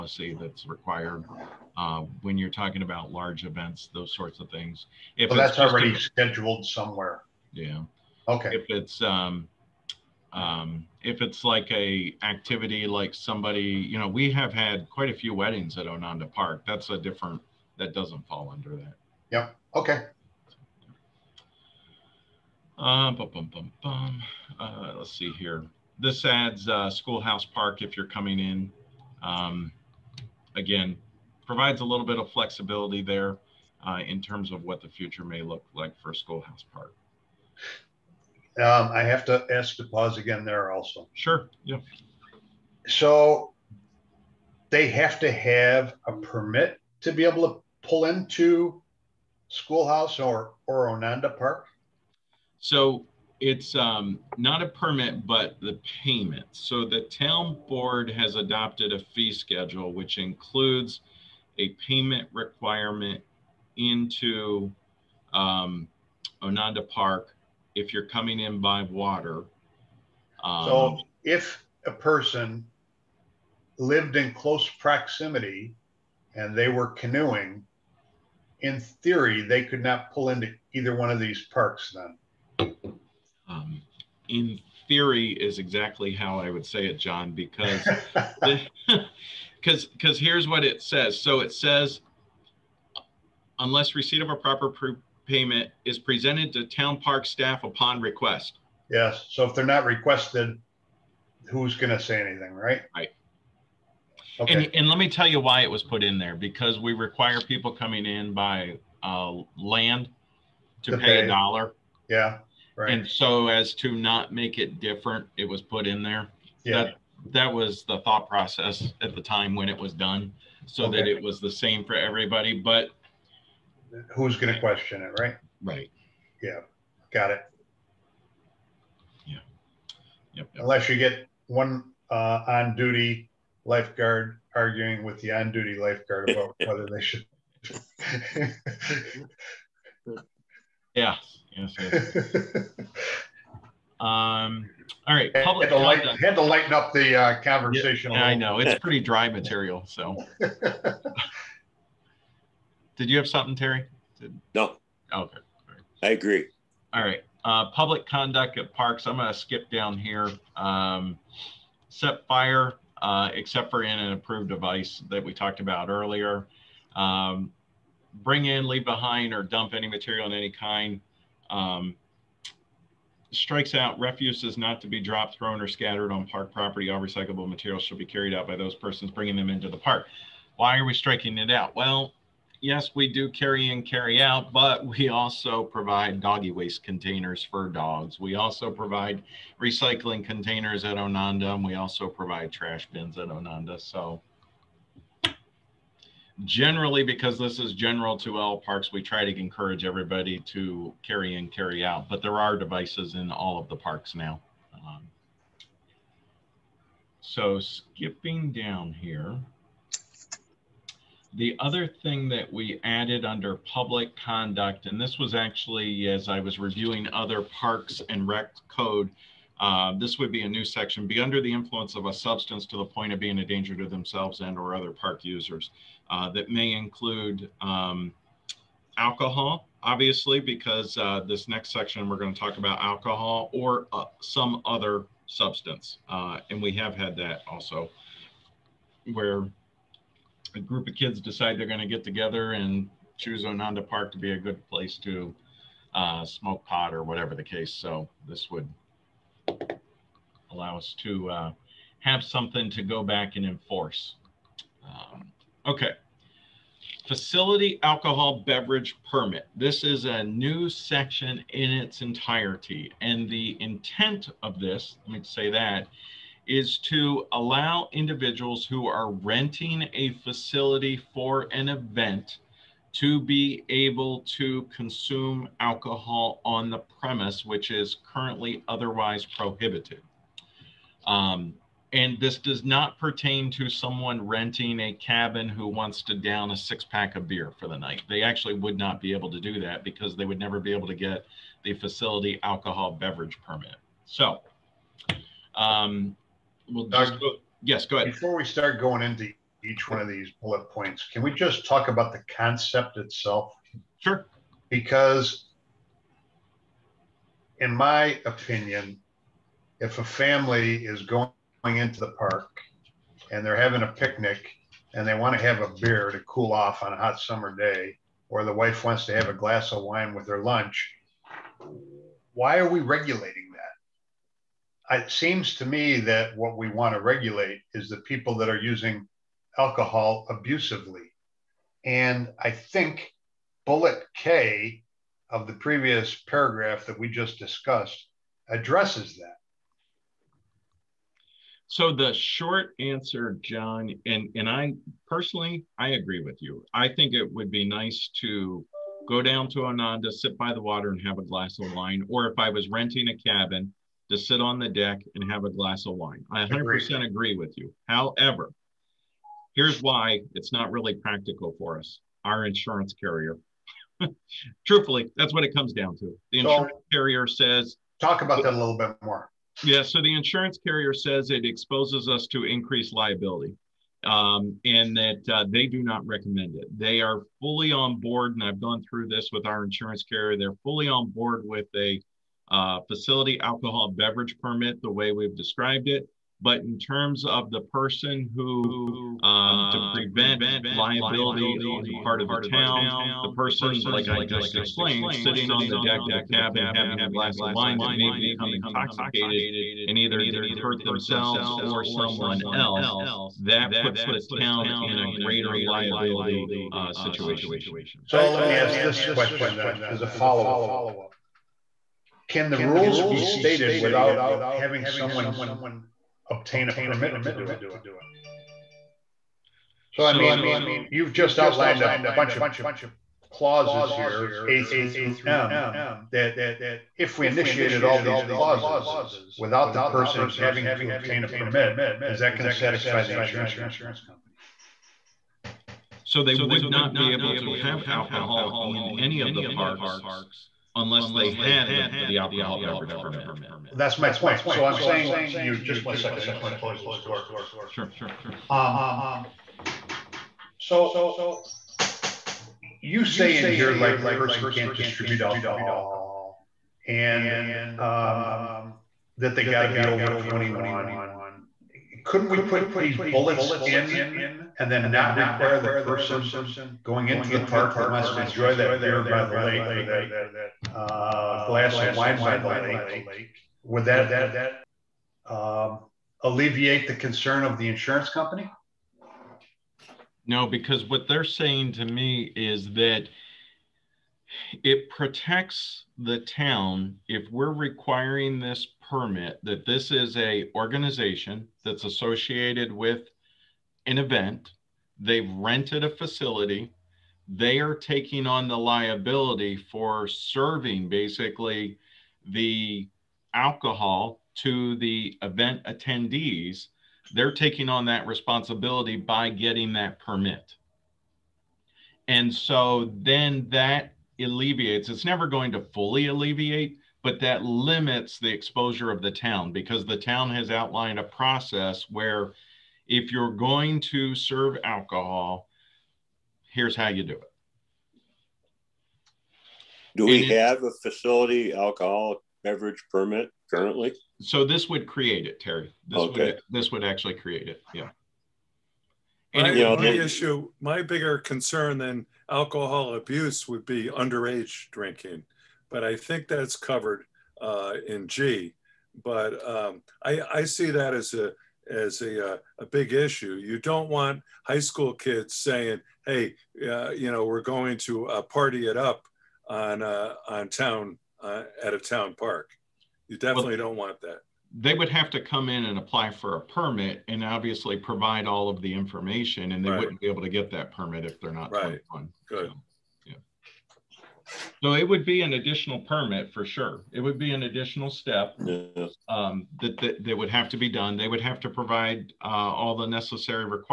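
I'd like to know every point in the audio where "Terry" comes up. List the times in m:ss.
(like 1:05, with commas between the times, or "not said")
2:33, 8:55.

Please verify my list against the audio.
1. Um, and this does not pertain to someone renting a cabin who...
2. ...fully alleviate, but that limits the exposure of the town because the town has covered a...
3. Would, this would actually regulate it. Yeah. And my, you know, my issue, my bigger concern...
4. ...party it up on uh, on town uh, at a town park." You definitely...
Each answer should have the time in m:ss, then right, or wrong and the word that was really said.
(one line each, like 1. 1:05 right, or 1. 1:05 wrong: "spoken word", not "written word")
1. 4:41 right
2. 8:35 wrong: "outlined", not "covered"
3. 8:56 wrong: "create", not "regulate"
4. 9:18 right.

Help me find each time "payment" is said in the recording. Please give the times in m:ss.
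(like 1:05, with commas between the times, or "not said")
0:56, 1:01, 1:35.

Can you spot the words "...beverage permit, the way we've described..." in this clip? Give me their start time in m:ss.
6:23.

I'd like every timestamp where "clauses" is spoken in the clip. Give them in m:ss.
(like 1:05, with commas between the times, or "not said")
7:03, 7:08.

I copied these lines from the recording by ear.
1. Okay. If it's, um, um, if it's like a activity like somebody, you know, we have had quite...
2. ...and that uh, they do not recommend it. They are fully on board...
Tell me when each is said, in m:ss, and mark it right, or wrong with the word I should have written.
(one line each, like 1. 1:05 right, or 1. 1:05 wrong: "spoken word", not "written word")
1. 0:08 right
2. 6:14 right.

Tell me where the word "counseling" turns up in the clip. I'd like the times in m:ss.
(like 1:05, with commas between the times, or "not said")
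not said.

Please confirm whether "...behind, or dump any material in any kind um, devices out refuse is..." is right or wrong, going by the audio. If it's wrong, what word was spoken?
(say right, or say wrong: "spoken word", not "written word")
wrong: "strikes", not "devices".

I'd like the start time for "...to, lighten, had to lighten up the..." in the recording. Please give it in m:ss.
2:25.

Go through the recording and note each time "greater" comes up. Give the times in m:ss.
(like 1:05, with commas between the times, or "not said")
6:45.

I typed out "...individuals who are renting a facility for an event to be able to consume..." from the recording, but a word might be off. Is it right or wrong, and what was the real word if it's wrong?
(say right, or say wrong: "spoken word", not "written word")
right.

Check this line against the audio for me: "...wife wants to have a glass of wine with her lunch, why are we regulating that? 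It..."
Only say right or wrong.
right.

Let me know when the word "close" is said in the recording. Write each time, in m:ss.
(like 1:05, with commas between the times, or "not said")
1:14, 7:26.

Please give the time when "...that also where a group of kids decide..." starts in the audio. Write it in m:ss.
3:57.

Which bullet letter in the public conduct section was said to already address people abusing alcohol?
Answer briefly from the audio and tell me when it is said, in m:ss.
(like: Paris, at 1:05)
K, at 5:33.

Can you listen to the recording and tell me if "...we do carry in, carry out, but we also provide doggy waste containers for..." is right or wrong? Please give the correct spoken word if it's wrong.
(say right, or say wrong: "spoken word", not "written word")
right.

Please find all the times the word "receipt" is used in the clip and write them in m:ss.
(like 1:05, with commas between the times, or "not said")
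1:33.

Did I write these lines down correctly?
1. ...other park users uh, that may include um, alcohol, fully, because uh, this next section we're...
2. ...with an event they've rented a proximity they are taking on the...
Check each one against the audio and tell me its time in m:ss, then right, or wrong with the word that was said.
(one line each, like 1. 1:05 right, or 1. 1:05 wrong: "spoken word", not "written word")
1. 3:44 wrong: "obviously", not "fully"
2. 8:12 wrong: "facility", not "proximity".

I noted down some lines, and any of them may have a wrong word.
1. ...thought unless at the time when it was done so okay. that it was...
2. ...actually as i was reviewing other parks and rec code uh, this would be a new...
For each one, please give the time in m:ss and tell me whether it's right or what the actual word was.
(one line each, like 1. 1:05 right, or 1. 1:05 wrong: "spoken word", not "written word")
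1. 1:57 wrong: "process", not "unless"
2. 3:35 right.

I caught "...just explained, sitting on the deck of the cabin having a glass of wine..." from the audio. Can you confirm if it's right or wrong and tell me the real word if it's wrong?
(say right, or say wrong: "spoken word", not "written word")
right.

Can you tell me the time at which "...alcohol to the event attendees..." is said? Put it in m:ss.
8:23.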